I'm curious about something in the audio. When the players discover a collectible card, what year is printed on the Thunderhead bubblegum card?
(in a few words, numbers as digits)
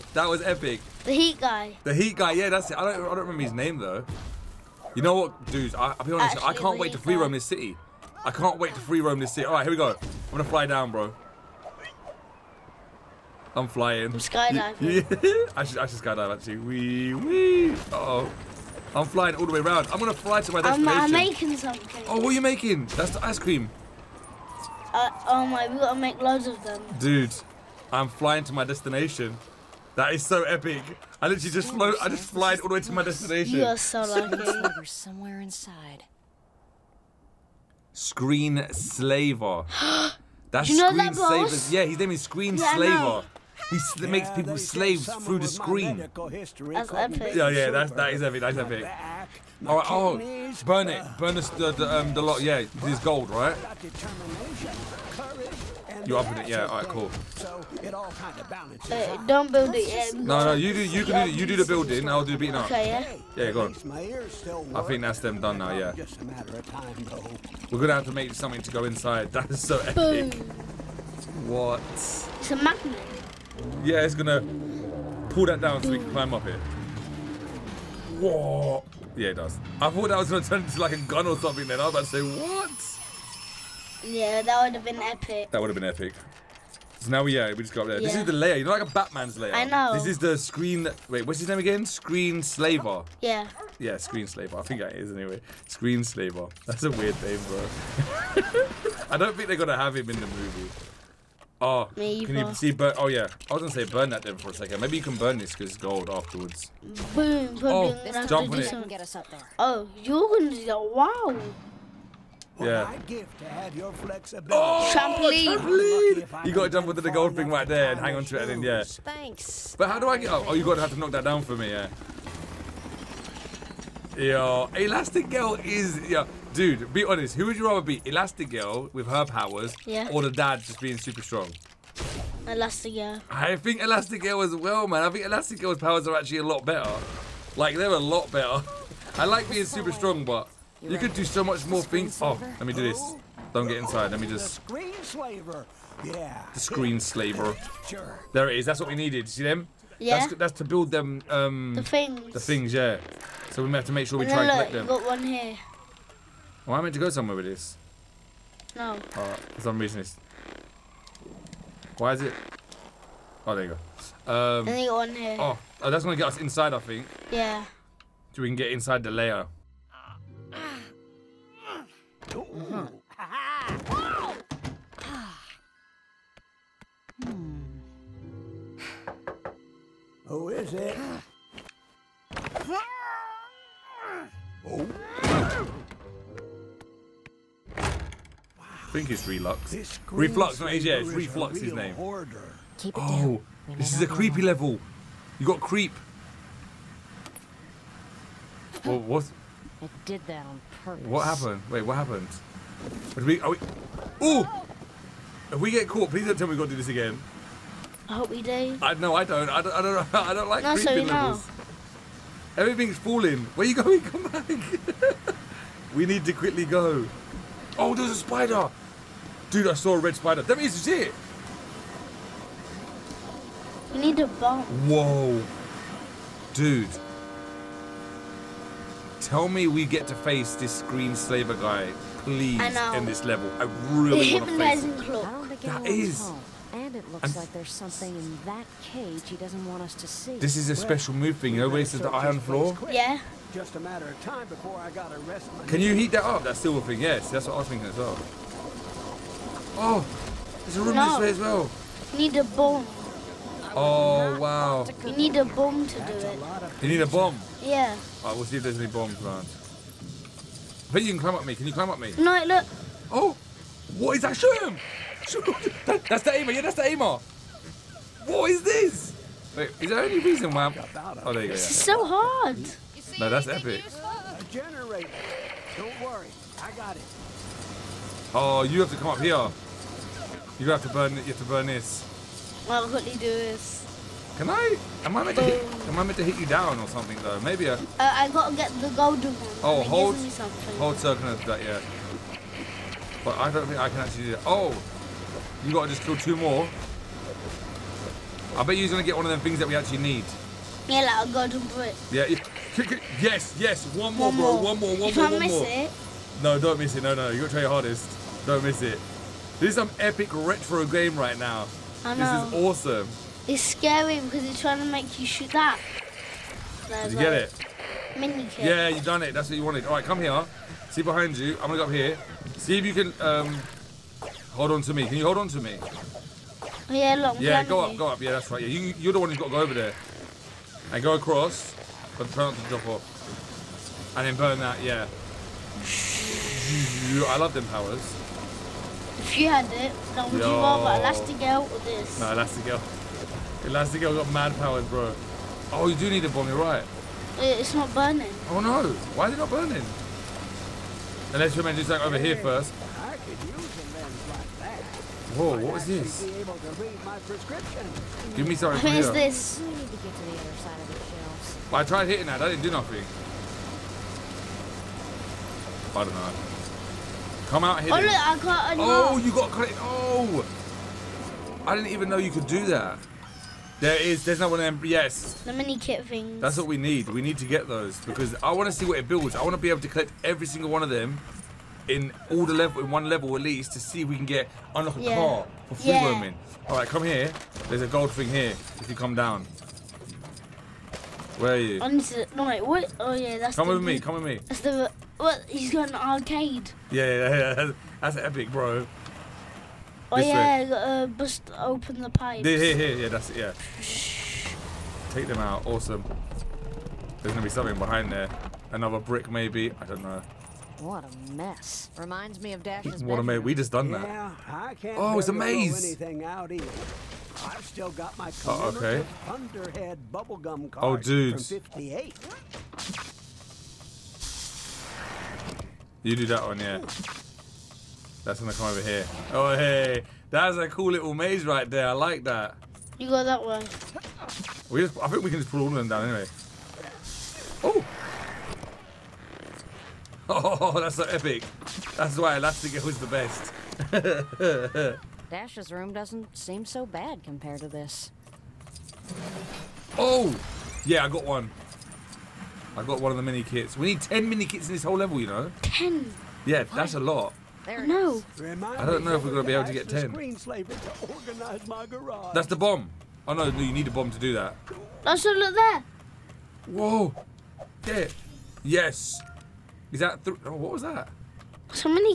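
1958.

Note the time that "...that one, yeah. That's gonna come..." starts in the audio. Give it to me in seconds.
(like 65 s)
426 s.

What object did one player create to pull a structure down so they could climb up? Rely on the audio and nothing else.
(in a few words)
a magnet.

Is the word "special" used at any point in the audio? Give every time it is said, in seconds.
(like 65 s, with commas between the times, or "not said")
240 s.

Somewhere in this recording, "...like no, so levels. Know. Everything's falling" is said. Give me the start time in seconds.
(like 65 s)
210 s.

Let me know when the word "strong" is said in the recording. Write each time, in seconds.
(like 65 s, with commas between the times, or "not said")
131 s, 139 s.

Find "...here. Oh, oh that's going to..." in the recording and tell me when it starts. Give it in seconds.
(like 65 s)
165 s.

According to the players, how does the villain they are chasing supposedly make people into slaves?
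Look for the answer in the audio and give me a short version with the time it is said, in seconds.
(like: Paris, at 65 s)
through the screen, at 45 s.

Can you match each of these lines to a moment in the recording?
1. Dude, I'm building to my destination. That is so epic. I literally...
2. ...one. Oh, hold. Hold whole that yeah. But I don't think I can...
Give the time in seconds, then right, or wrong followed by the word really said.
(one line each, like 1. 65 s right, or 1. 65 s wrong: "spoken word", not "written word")
1. 26 s wrong: "flying", not "building"
2. 289 s wrong: "circle", not "whole".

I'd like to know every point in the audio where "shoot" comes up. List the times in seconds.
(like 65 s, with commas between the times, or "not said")
264 s, 315 s.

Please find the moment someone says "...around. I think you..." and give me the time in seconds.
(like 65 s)
259 s.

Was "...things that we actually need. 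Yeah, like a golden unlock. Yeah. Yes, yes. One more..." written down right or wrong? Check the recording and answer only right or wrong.
wrong.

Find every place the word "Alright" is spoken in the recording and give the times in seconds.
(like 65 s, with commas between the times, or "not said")
258 s.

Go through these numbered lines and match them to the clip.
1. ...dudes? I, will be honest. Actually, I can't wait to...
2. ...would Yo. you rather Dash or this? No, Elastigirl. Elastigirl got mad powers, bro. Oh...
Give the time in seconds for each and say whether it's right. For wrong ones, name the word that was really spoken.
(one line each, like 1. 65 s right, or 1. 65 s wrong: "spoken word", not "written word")
1. 5 s right
2. 340 s wrong: "Elastigirl", not "Dash".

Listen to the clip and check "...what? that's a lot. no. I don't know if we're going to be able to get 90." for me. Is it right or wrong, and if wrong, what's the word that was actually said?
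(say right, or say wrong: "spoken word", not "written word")
wrong: "10", not "90".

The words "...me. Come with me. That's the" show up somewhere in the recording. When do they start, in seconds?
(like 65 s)
393 s.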